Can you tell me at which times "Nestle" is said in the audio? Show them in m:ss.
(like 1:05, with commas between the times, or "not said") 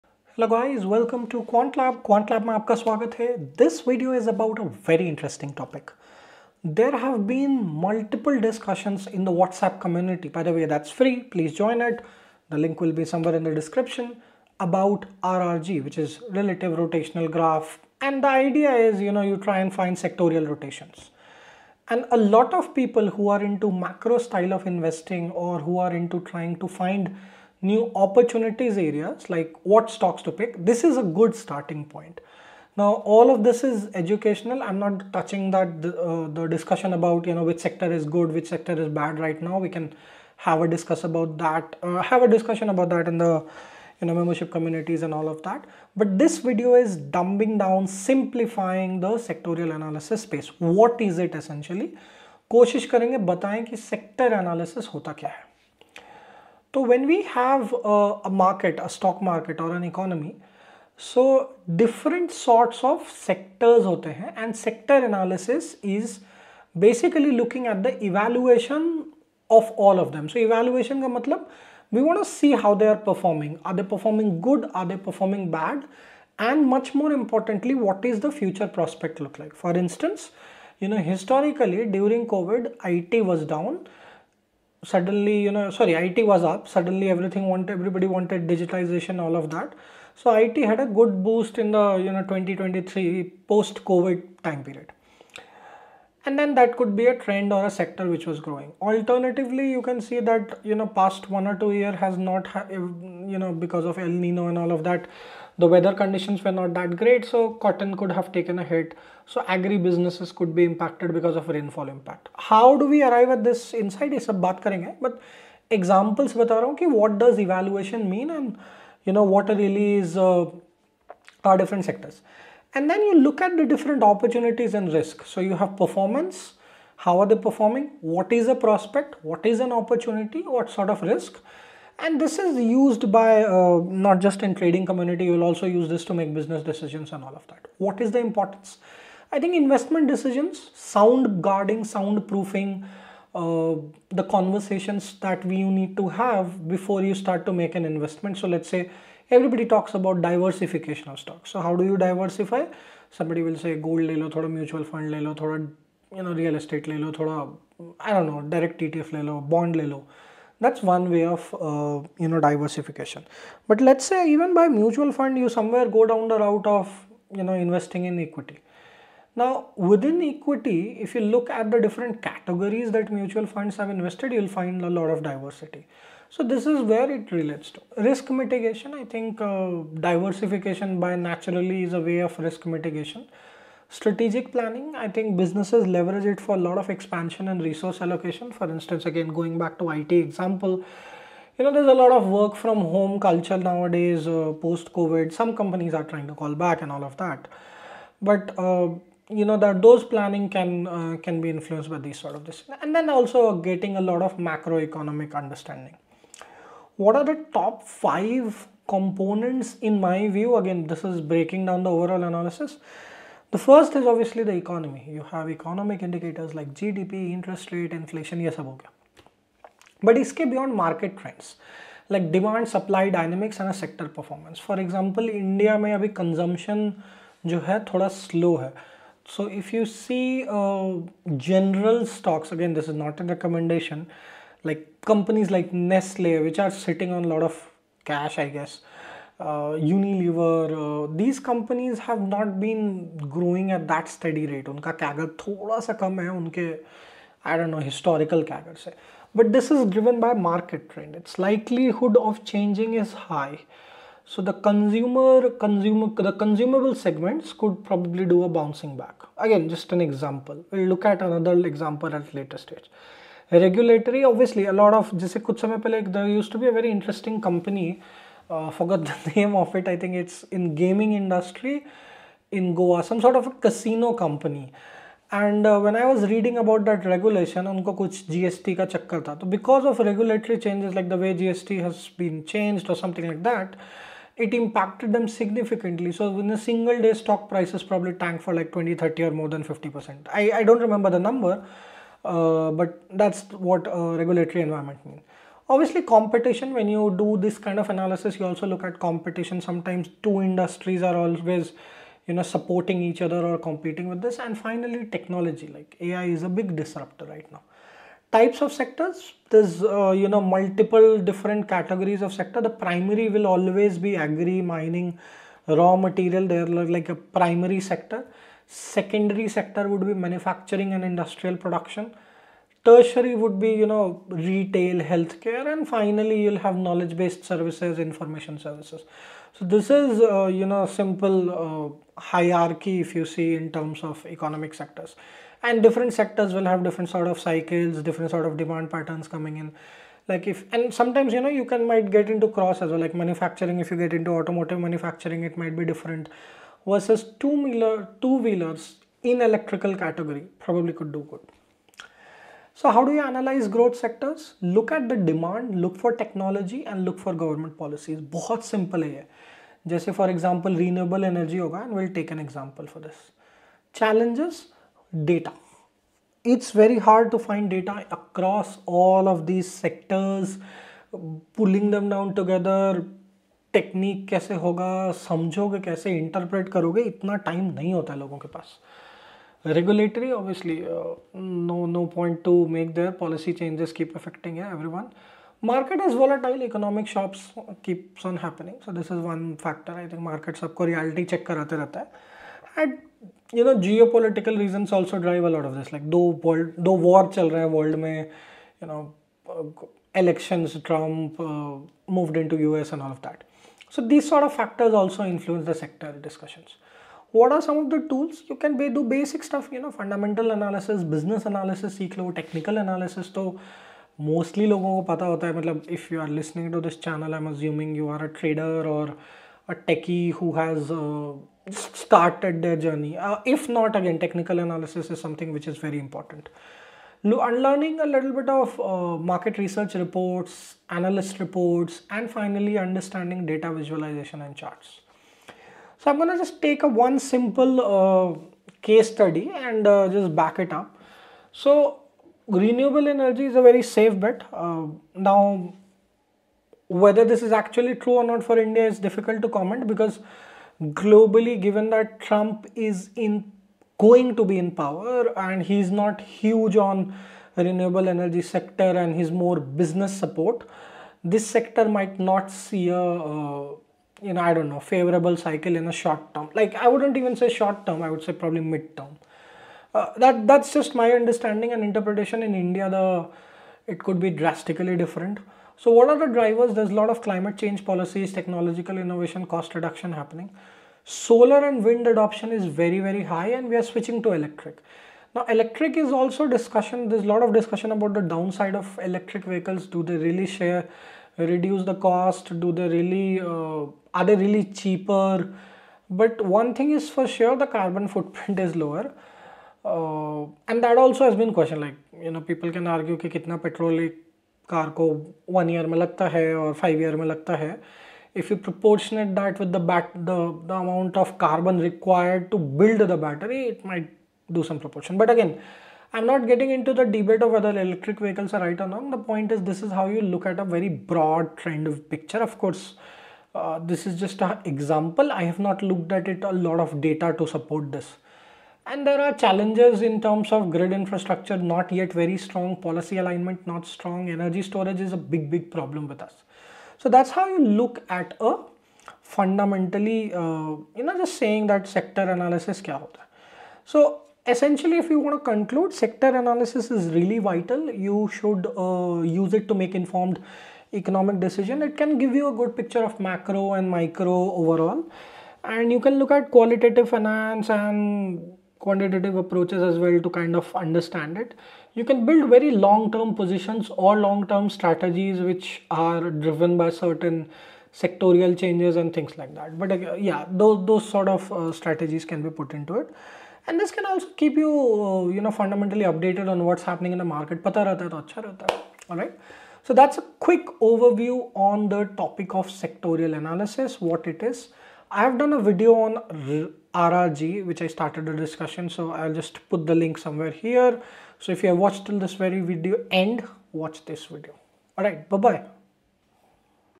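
3:55.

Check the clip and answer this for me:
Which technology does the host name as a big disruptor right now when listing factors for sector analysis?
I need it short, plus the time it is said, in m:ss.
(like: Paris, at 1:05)
AI, at 5:06.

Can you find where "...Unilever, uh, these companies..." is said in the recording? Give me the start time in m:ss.
3:59.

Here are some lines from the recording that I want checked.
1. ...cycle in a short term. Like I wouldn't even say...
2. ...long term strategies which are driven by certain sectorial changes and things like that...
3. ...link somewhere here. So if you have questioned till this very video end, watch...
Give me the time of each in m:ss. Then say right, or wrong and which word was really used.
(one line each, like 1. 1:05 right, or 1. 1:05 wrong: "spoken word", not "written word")
1. 7:45 right
2. 9:24 right
3. 9:49 wrong: "watched", not "questioned".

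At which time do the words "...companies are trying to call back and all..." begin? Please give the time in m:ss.
3:15.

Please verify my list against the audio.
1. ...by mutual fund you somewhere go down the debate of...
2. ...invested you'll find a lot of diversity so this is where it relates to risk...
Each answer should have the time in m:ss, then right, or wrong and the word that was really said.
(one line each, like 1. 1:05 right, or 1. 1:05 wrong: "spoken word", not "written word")
1. 2:44 wrong: "route", not "debate"
2. 2:53 right.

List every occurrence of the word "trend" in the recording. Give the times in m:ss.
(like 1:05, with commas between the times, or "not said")
1:37, 3:41, 8:41.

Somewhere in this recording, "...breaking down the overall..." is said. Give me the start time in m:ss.
3:31.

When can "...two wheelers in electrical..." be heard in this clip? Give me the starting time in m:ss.
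5:48.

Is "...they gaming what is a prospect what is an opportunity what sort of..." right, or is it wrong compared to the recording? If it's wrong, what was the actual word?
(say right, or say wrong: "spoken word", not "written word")
wrong: "performing", not "gaming".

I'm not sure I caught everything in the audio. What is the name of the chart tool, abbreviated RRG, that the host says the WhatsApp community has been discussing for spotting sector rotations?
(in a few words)
Relative rotational graph.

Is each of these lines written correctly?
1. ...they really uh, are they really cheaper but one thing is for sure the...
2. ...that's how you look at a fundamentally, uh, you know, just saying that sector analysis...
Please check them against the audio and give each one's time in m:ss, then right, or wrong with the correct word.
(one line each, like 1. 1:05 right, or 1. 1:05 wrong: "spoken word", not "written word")
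1. 8:12 right
2. 8:57 right.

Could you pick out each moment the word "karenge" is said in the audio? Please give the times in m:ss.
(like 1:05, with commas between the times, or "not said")
1:54.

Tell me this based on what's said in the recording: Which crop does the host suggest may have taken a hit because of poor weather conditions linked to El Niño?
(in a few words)
Cotton.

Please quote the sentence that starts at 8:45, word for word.
I have not looked at it a lot of data to support this.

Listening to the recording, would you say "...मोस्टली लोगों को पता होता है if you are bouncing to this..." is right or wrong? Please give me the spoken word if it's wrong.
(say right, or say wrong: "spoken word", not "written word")
wrong: "listening", not "bouncing".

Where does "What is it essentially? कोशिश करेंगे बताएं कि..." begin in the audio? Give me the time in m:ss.
0:50.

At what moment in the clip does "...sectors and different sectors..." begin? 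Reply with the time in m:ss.
5:34.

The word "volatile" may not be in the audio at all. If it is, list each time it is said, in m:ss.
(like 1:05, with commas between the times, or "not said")
6:26.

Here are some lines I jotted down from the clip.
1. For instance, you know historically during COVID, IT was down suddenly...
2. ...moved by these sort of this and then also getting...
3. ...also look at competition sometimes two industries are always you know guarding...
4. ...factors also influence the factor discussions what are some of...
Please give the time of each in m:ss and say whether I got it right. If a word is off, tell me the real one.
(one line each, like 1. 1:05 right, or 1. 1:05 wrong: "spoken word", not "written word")
1. 1:19 right
2. 3:21 wrong: "influenced", not "moved"
3. 4:58 wrong: "supporting", not "guarding"
4. 6:44 wrong: "sector", not "factor".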